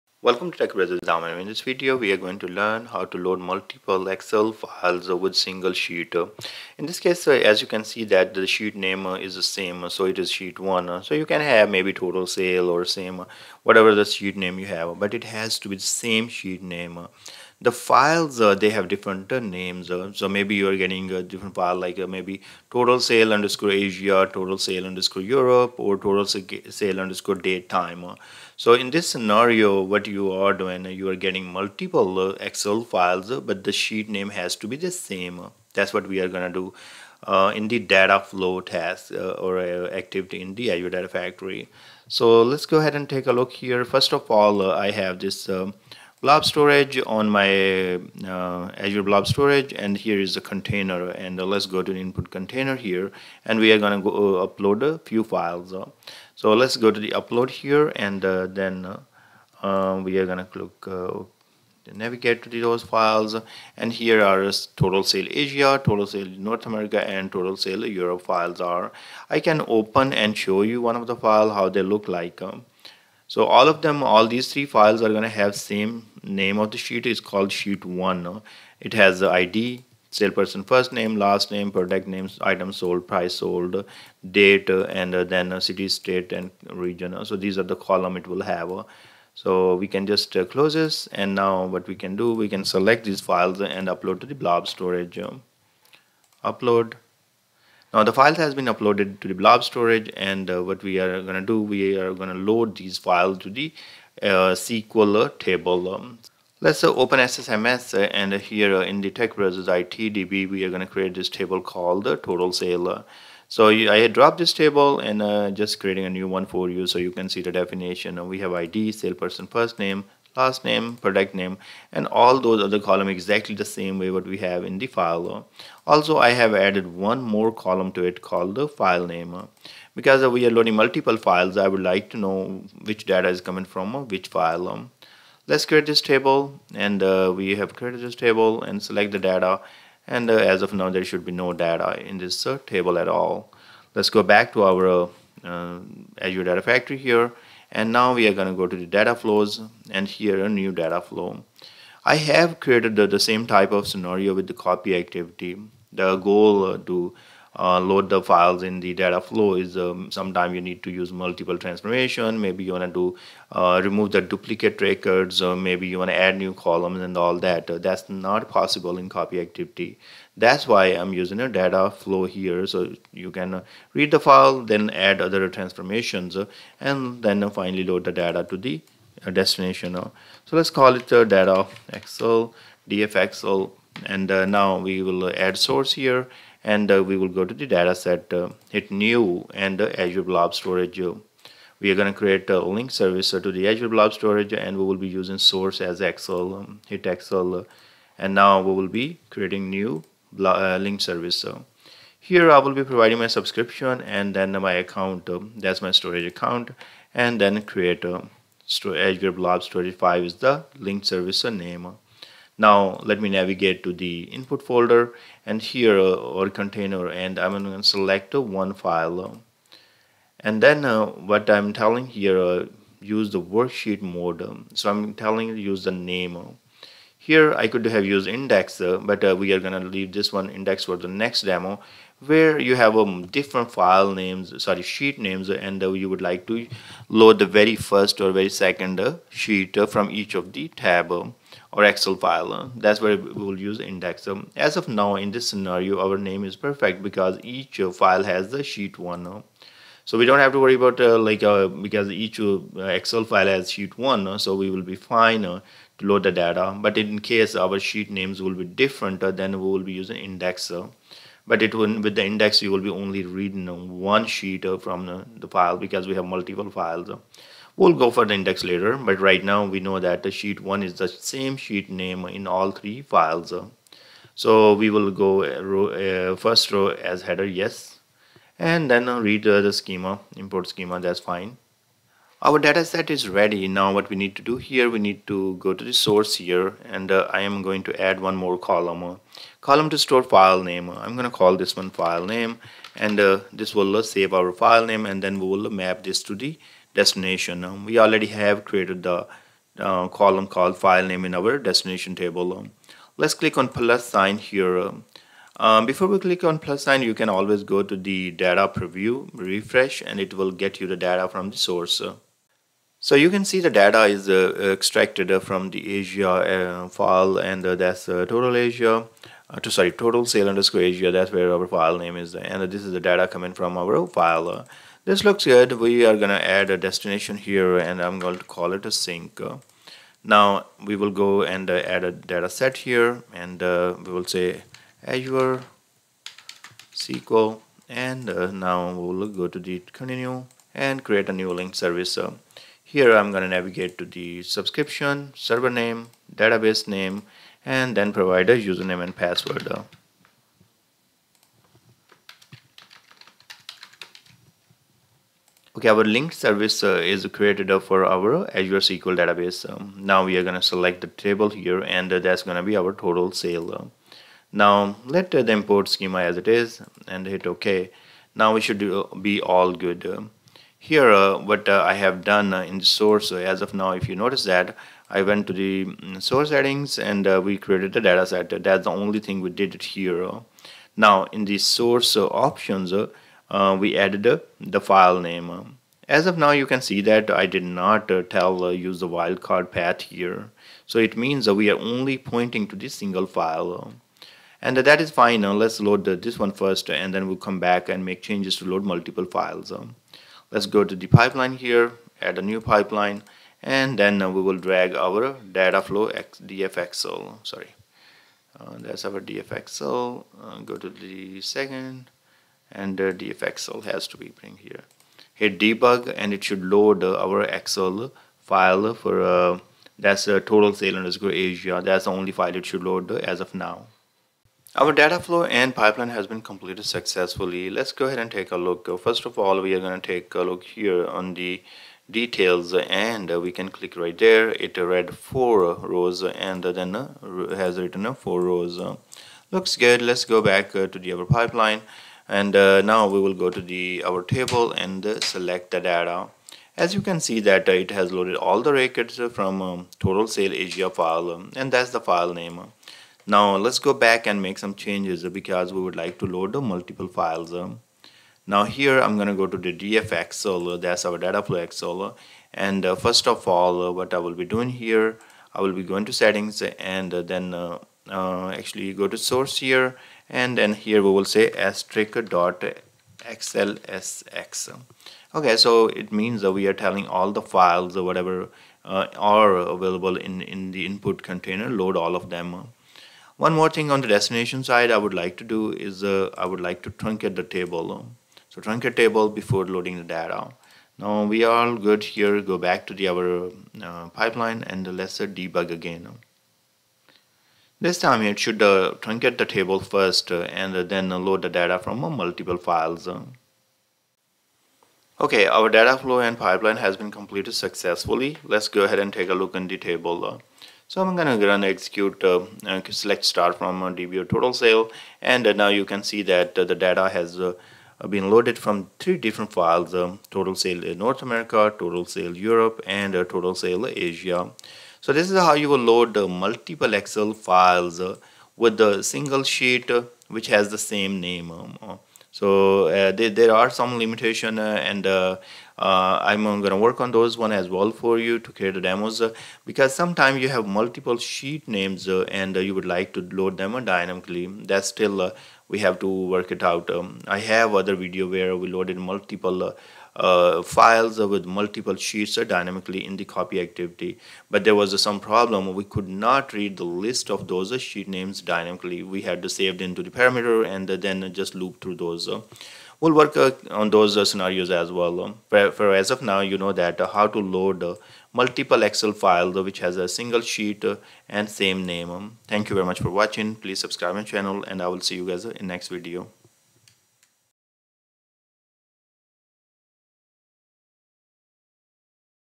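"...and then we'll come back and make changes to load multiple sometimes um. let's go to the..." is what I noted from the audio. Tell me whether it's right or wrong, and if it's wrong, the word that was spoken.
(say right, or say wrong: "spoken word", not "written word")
wrong: "files", not "sometimes".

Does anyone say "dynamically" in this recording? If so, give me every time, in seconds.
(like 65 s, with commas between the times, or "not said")
543 s, 552 s, 558 s.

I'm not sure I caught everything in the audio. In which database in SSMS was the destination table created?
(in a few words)
TechBrothersITDB.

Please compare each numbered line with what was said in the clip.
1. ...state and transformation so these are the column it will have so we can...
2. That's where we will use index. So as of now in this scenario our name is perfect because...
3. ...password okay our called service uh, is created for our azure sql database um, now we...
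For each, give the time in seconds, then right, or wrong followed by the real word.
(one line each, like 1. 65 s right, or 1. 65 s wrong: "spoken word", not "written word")
1. 85 s wrong: "region", not "transformation"
2. 242 s right
3. 349 s wrong: "linked", not "called".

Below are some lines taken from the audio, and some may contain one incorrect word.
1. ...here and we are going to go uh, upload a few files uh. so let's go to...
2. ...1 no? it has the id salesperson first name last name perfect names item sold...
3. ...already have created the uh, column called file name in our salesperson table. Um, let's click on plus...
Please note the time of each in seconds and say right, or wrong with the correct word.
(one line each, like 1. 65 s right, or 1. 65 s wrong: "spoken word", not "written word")
1. 52 s right
2. 77 s wrong: "product", not "perfect"
3. 297 s wrong: "destination", not "salesperson".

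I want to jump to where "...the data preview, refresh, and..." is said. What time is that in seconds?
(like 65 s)
307 s.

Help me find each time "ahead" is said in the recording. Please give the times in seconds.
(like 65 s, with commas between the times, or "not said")
42 s, 428 s, 508 s.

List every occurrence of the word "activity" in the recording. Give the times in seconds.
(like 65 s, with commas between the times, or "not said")
39 s, 154 s, 169 s, 553 s.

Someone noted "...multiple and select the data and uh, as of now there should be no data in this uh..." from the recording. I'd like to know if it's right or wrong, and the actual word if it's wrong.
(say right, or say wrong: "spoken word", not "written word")
wrong: "table", not "multiple".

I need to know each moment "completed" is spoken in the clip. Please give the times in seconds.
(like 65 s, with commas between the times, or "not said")
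426 s, 507 s.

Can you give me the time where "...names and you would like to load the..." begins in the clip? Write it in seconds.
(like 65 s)
235 s.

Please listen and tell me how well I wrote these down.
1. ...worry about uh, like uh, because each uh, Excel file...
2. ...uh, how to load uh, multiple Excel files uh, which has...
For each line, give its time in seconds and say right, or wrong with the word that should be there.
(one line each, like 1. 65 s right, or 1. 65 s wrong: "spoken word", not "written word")
1. 250 s right
2. 567 s right.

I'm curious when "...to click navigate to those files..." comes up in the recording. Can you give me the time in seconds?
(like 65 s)
60 s.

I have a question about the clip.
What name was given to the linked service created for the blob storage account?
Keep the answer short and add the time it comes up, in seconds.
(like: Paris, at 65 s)
Azure Blob Storage 5, at 208 s.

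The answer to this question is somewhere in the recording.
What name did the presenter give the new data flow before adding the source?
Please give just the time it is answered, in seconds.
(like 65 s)
182 s.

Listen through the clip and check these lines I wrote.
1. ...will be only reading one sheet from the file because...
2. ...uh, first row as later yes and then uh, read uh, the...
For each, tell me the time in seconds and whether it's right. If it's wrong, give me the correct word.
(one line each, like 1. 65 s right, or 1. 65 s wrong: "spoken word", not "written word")
1. 262 s right
2. 276 s wrong: "header", not "later".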